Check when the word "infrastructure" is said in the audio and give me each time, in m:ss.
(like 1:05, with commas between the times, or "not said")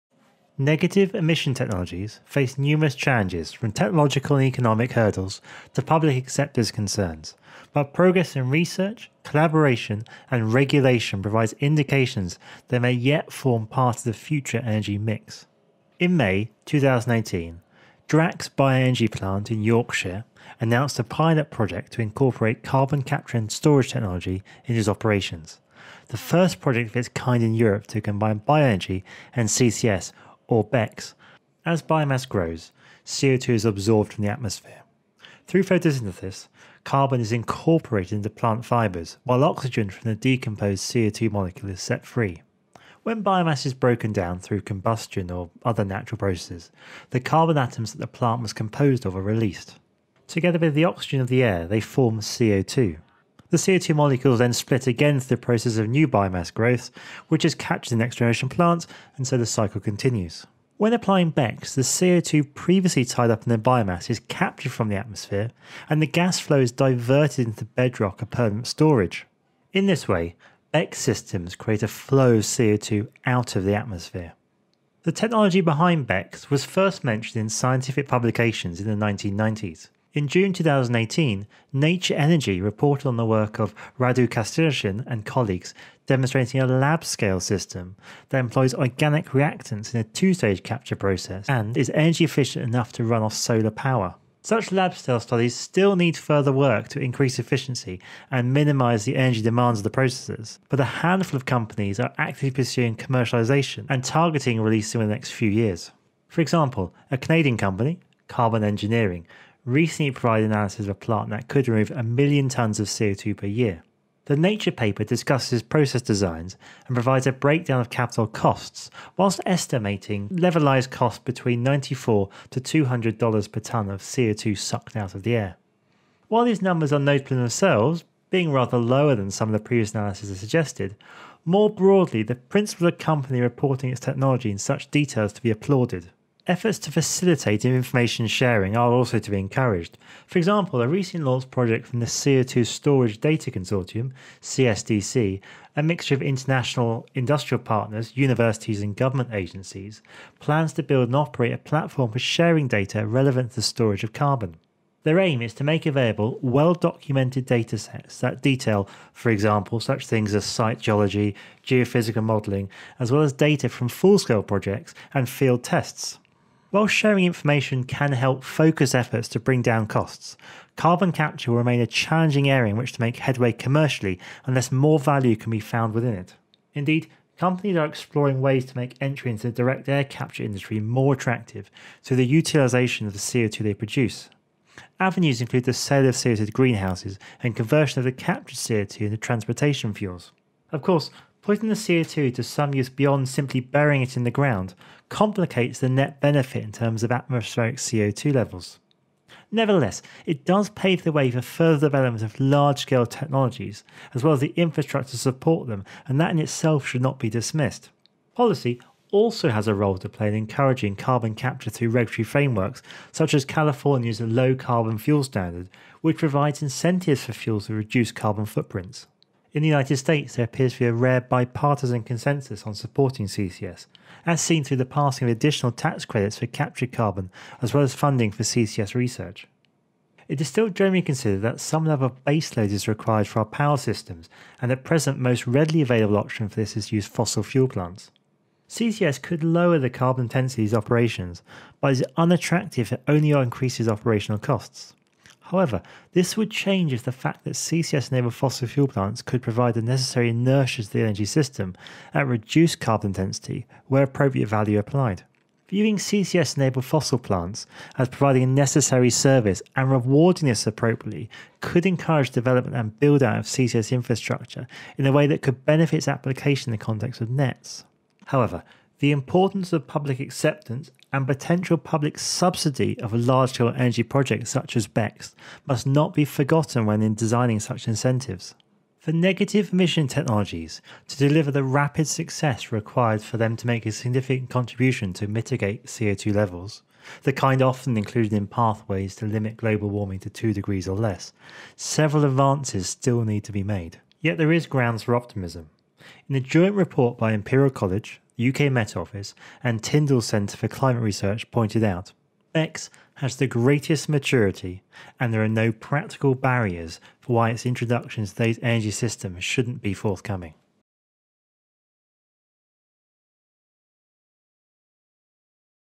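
3:24, 4:23.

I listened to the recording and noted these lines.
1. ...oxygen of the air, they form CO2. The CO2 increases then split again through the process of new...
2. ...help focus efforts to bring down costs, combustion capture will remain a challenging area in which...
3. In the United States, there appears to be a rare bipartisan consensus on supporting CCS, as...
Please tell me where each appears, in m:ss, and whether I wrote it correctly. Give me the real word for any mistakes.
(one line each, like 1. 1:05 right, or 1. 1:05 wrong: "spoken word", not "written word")
1. 0:50 wrong: "molecules", not "increases"
2. 2:48 wrong: "carbon", not "combustion"
3. 3:39 right.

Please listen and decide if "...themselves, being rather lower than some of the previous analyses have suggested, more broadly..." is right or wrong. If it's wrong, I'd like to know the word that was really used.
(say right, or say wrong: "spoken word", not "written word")
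right.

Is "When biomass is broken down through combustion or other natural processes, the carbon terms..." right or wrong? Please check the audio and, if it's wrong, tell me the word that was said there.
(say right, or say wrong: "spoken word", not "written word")
wrong: "atoms", not "terms".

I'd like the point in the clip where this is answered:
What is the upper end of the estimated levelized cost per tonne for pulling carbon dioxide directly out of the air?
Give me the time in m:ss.
2:02.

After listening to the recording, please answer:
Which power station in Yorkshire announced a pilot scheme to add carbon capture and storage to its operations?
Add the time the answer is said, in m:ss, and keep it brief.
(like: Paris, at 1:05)
Drax Bioenergy Plant, at 0:18.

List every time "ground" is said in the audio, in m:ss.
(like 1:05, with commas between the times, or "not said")
3:14, 4:54.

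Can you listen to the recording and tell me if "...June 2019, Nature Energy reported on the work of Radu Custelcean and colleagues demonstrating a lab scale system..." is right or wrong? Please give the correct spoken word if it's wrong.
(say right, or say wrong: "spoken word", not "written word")
wrong: "2018", not "2019".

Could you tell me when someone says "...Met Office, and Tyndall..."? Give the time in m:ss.
4:58.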